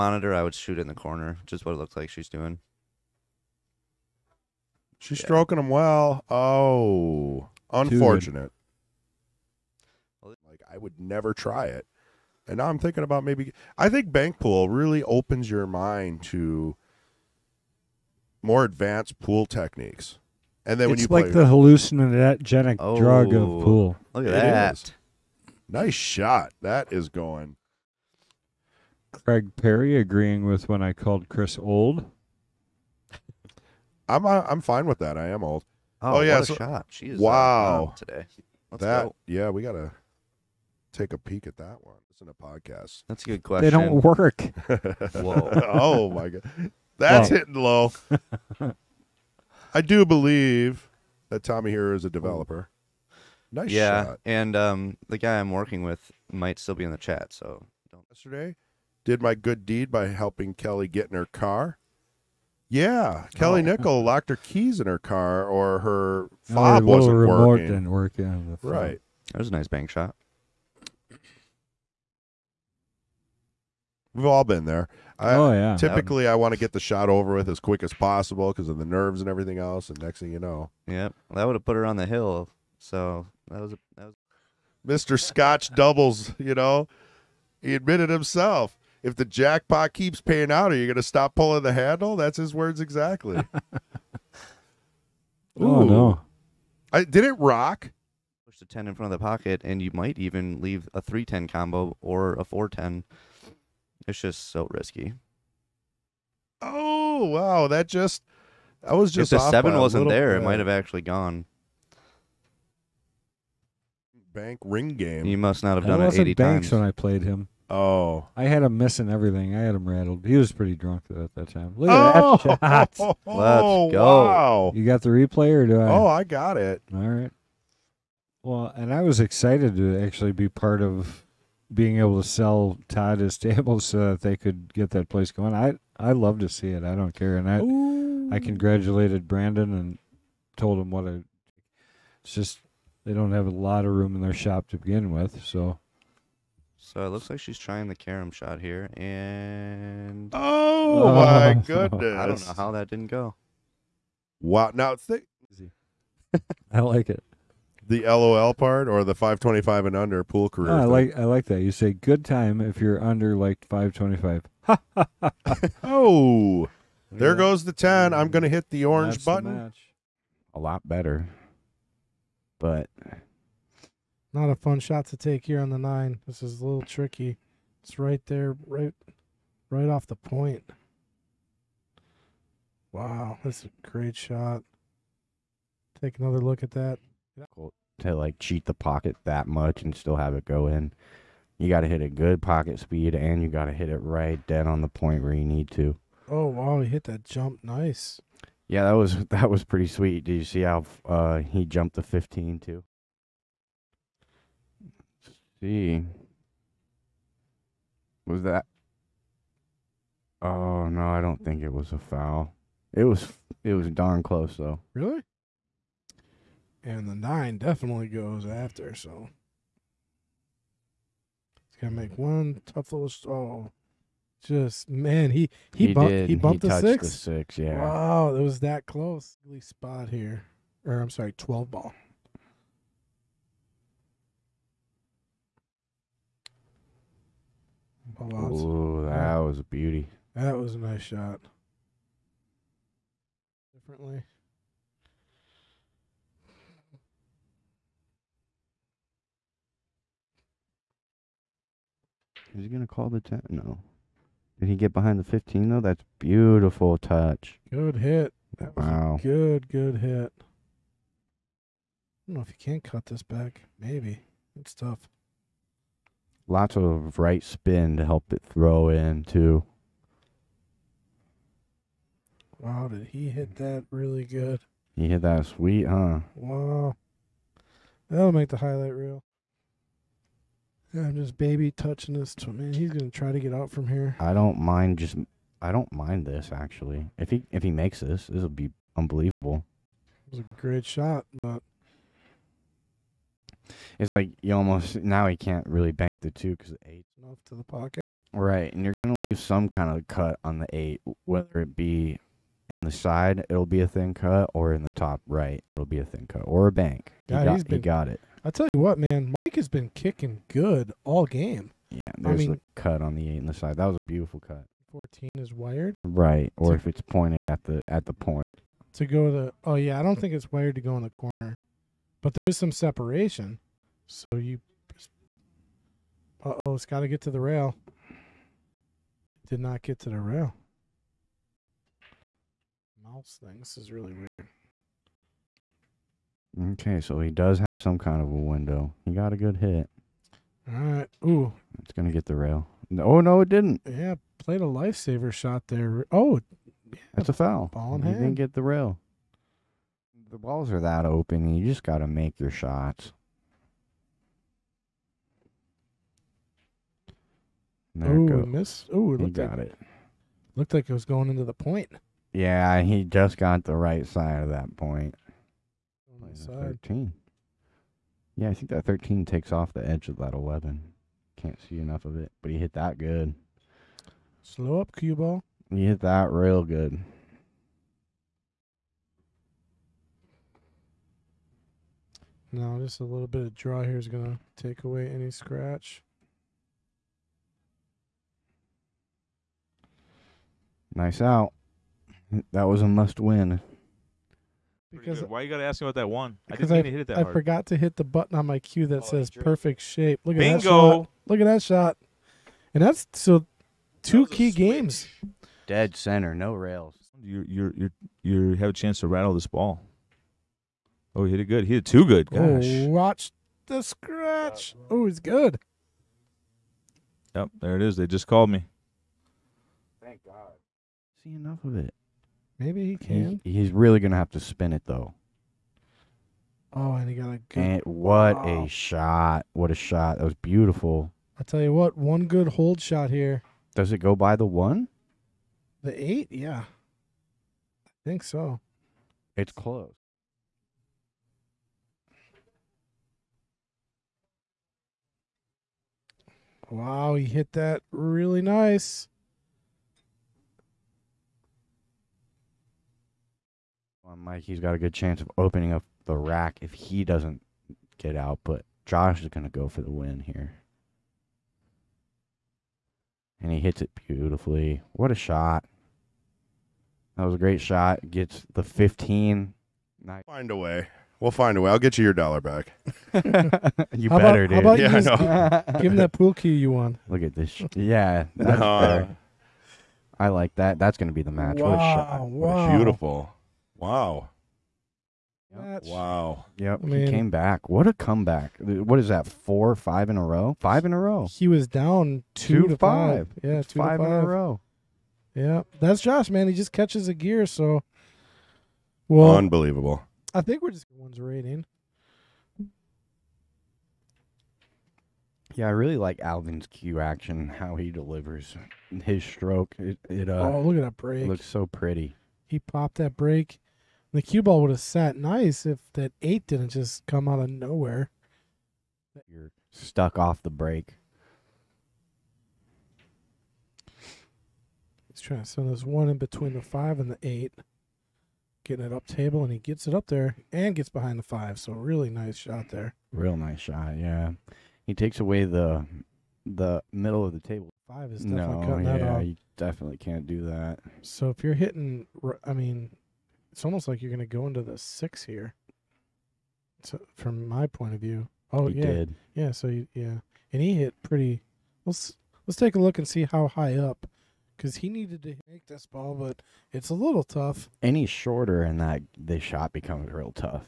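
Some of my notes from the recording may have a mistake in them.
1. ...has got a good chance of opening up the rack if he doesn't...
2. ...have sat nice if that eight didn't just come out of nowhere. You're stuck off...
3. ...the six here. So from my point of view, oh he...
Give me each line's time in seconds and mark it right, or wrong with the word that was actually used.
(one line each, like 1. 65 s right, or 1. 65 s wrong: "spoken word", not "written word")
1. 454 s right
2. 514 s right
3. 544 s right.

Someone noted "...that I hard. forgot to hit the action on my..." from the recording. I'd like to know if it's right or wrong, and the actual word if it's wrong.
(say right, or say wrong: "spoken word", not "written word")
wrong: "button", not "action".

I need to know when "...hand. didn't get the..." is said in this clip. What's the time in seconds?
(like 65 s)
348 s.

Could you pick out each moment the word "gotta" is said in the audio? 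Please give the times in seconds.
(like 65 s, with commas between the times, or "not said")
39 s, 395 s.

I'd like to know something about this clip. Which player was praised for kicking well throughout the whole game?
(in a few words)
Mike.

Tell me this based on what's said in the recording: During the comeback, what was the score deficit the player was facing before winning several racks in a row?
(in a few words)
2 to 5.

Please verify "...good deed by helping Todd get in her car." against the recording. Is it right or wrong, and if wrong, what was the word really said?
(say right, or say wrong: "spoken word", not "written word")
wrong: "Kelly", not "Todd".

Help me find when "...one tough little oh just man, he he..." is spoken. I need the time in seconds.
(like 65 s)
222 s.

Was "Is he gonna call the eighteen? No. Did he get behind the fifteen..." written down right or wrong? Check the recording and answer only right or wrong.
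wrong.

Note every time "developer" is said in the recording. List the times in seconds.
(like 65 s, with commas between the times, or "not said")
52 s.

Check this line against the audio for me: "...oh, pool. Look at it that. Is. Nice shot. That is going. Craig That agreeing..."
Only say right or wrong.
wrong.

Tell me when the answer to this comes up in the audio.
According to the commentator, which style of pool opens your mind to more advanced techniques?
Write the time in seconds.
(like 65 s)
14 s.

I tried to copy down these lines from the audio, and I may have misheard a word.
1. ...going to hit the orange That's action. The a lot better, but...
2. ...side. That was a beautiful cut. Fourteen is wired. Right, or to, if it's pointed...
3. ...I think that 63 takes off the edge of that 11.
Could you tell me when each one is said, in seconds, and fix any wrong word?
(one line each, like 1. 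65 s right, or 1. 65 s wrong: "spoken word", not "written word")
1. 168 s wrong: "button", not "action"
2. 313 s right
3. 368 s wrong: "13", not "63".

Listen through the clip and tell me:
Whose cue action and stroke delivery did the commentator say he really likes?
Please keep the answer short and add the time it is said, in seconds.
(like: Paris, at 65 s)
Alvin, at 506 s.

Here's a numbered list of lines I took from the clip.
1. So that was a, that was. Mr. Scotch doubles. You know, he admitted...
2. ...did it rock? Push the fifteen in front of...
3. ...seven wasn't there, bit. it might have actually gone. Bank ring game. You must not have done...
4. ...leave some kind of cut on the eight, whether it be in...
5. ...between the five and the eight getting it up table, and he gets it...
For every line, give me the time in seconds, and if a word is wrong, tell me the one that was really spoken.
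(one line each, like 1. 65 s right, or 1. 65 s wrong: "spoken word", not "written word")
1. 82 s right
2. 97 s wrong: "ten", not "fifteen"
3. 109 s right
4. 299 s right
5. 526 s right.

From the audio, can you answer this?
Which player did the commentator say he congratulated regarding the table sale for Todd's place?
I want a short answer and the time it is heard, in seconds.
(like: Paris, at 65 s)
Brandon, at 139 s.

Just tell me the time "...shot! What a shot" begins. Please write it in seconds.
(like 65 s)
428 s.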